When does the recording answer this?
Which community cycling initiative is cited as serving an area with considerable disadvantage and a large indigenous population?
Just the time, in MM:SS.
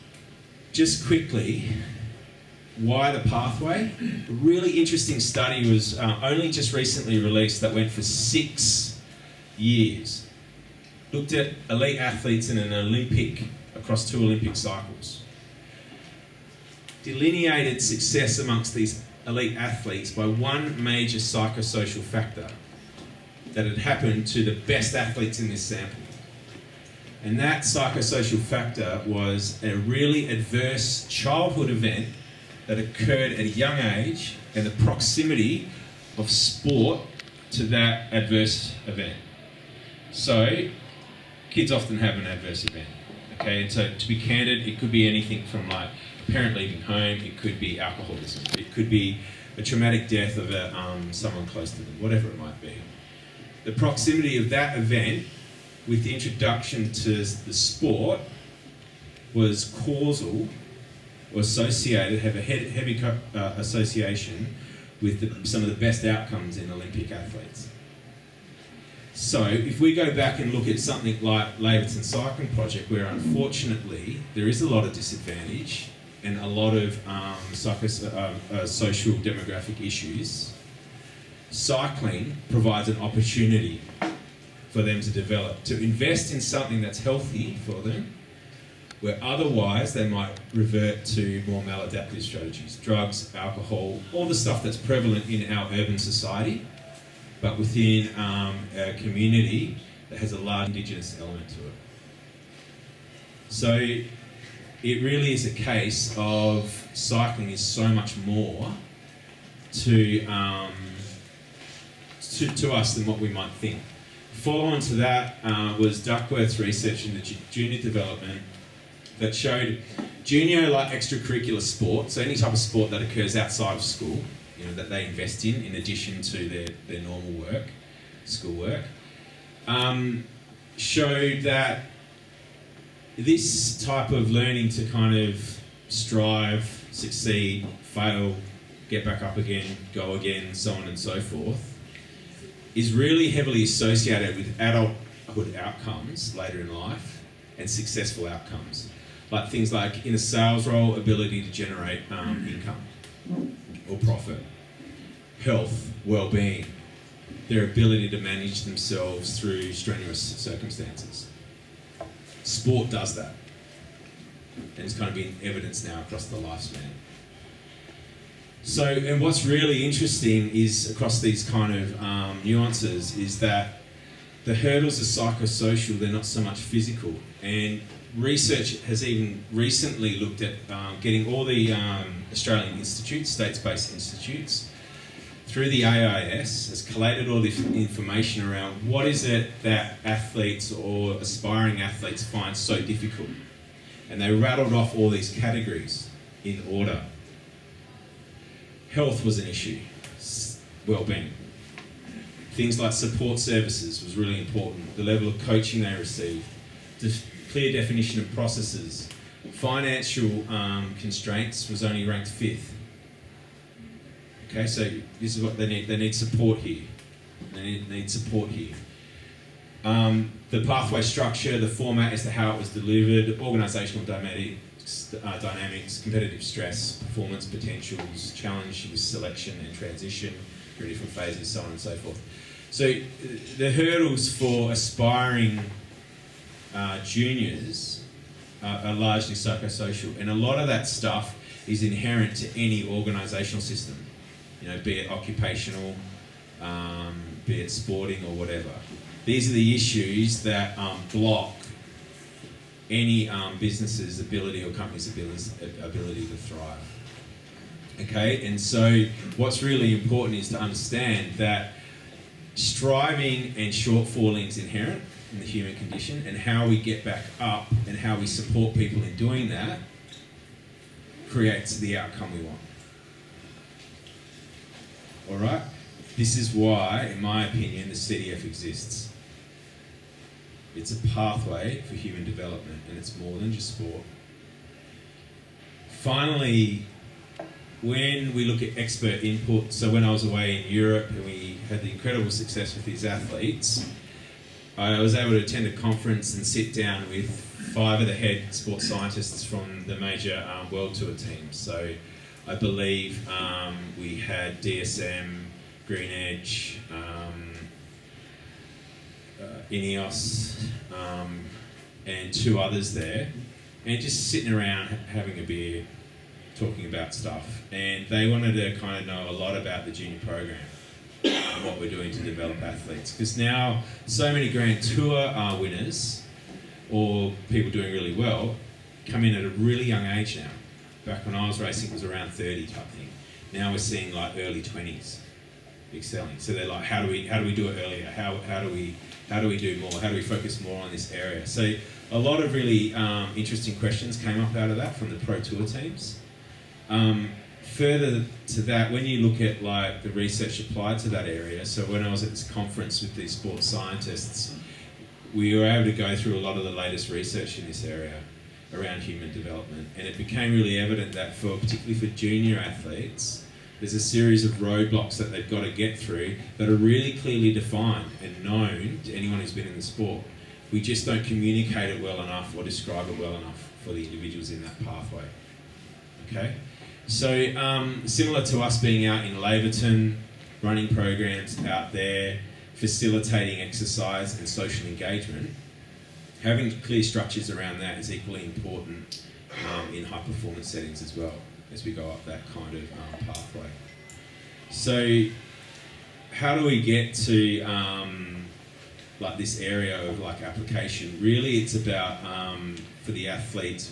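01:11.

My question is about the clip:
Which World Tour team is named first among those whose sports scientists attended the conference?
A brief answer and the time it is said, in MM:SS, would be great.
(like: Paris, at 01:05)
DSM, at 05:04.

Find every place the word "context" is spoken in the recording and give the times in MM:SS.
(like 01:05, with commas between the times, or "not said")
not said.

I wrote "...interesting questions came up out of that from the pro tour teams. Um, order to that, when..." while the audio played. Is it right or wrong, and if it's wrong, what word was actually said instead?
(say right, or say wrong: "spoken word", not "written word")
wrong: "further", not "order".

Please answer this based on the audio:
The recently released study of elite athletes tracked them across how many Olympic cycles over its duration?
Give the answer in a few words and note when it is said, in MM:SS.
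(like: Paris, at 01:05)
2, at 00:14.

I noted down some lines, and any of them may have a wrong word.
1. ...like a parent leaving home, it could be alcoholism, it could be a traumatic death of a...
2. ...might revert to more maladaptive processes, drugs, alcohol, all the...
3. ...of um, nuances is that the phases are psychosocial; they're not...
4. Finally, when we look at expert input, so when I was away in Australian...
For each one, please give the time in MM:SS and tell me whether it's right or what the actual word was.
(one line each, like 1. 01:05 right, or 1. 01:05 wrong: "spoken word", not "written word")
1. 00:45 right
2. 01:30 wrong: "strategies", not "processes"
3. 02:51 wrong: "hurdles", not "phases"
4. 04:46 wrong: "Europe", not "Australian".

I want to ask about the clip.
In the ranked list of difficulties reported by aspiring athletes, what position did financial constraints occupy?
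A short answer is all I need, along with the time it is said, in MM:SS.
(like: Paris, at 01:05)
fifth, at 03:32.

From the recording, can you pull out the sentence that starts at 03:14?
And they rattled off all these categories in order.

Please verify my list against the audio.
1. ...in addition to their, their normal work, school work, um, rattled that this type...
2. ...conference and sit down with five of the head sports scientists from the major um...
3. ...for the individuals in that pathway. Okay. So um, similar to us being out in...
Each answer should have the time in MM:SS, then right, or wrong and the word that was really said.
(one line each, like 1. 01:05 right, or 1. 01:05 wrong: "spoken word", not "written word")
1. 02:05 wrong: "showed", not "rattled"
2. 04:55 right
3. 06:13 right.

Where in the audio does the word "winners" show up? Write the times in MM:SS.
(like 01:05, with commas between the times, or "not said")
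05:25.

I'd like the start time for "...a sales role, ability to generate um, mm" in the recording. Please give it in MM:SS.
02:30.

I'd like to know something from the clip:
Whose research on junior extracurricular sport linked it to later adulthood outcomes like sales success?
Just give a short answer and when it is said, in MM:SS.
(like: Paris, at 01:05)
Duckworth, at 01:56.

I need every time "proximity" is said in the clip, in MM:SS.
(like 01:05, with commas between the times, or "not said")
00:34, 00:53.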